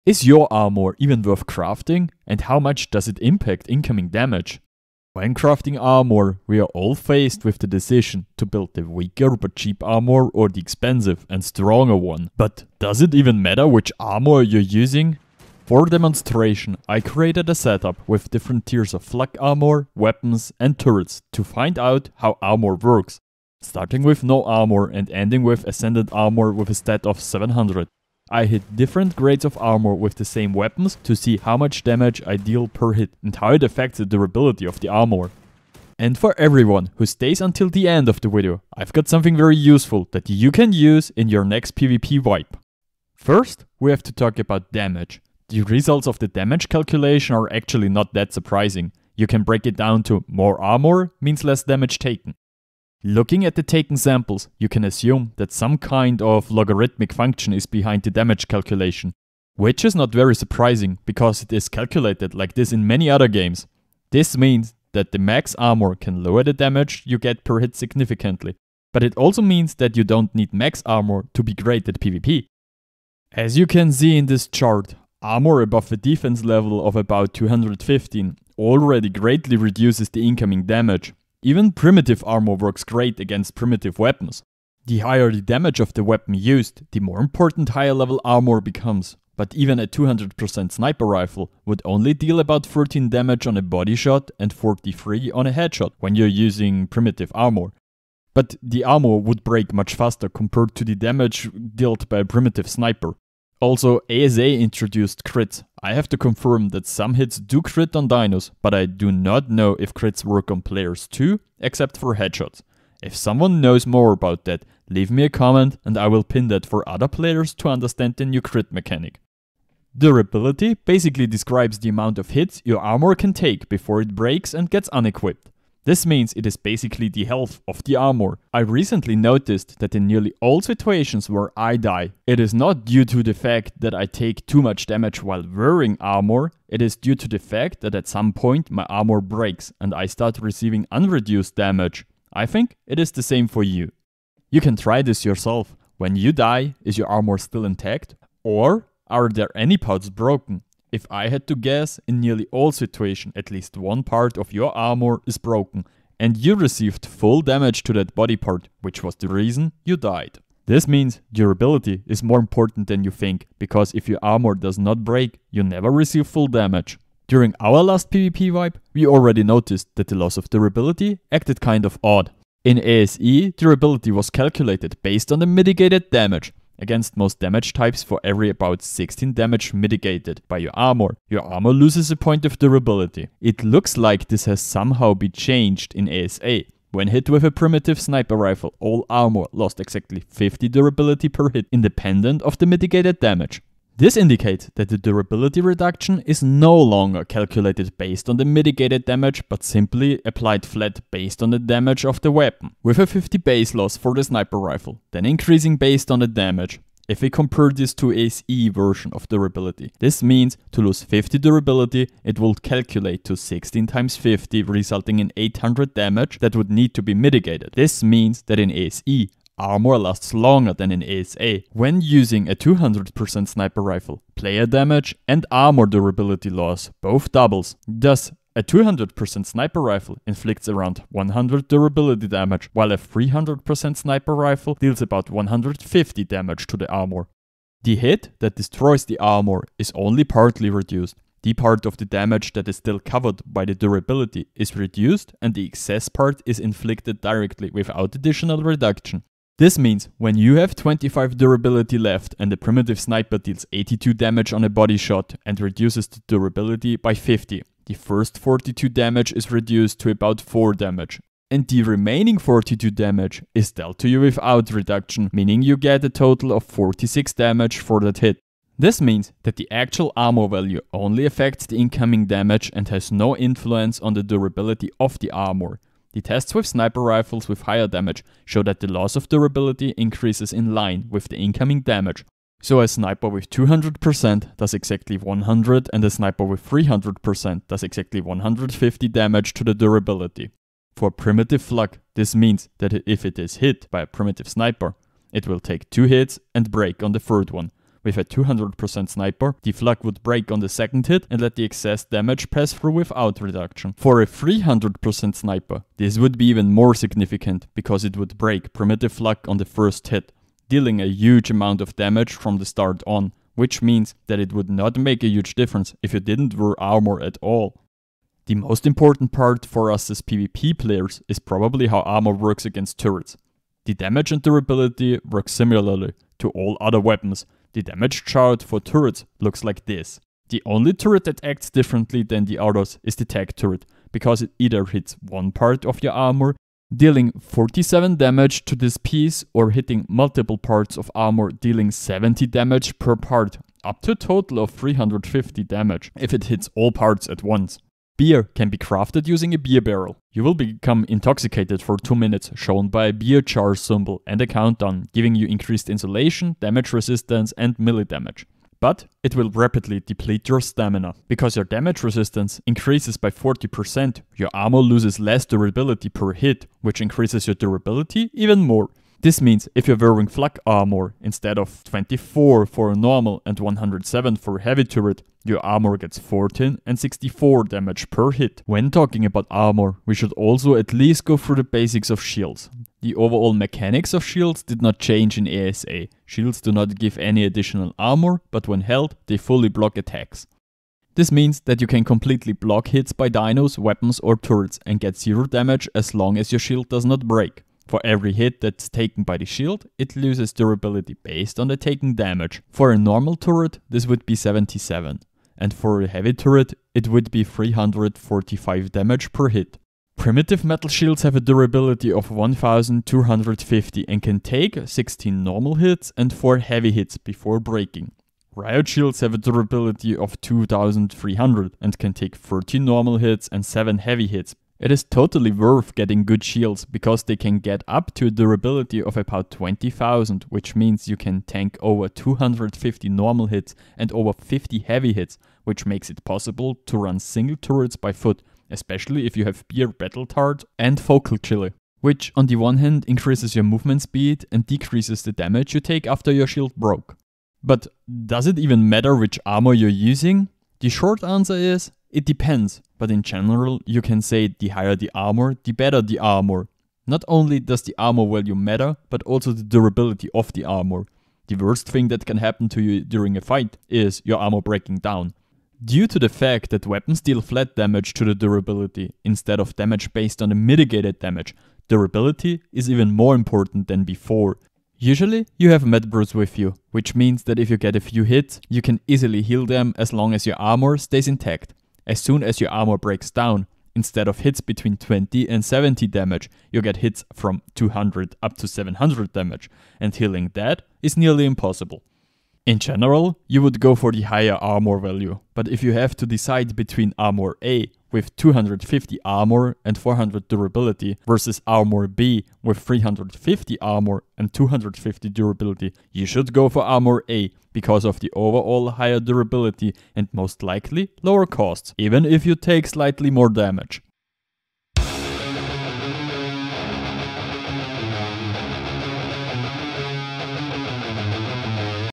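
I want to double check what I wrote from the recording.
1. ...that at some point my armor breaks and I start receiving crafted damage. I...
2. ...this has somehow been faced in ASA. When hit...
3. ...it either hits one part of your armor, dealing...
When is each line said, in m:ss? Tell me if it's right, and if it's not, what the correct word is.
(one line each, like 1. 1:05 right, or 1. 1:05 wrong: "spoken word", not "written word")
1. 2:17 wrong: "unreduced", not "crafted"
2. 3:04 wrong: "changed", not "faced"
3. 5:34 right.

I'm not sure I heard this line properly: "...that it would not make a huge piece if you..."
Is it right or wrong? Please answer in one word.
wrong.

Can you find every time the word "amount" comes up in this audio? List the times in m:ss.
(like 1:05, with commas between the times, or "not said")
2:01, 5:11.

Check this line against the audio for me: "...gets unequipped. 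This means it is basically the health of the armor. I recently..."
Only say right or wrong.
right.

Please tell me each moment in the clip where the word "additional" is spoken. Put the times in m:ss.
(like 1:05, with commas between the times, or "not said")
4:08, 6:27.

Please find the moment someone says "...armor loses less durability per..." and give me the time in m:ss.
6:04.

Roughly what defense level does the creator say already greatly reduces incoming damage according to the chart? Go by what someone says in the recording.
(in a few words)
215.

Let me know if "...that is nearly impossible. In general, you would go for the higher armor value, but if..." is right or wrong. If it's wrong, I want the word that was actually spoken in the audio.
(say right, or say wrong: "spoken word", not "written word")
right.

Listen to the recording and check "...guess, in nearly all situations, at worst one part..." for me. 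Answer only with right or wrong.
wrong.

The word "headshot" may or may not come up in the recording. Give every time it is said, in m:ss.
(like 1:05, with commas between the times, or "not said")
1:35, 1:52.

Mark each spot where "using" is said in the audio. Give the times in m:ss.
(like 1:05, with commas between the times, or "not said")
0:14, 1:36, 3:42, 5:49, 7:30.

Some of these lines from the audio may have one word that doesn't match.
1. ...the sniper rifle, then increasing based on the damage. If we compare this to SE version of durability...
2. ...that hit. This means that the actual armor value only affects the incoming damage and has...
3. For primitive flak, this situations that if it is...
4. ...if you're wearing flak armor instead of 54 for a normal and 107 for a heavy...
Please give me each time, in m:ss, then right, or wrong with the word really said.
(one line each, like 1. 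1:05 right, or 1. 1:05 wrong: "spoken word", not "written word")
1. 3:24 right
2. 4:27 right
3. 4:50 wrong: "means", not "situations"
4. 6:09 wrong: "24", not "54".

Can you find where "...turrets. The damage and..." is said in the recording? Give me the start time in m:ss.
5:22.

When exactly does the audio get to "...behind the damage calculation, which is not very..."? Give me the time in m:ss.
0:57.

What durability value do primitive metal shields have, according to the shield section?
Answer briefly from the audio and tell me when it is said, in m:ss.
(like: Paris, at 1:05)
1250, at 6:52.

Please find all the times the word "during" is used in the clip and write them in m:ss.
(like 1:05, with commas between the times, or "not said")
2:47, 7:43.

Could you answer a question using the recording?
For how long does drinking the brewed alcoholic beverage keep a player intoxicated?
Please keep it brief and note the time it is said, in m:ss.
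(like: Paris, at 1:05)
2 minutes, at 5:51.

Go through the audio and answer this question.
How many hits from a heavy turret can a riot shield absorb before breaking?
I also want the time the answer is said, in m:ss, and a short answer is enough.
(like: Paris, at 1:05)
7, at 7:03.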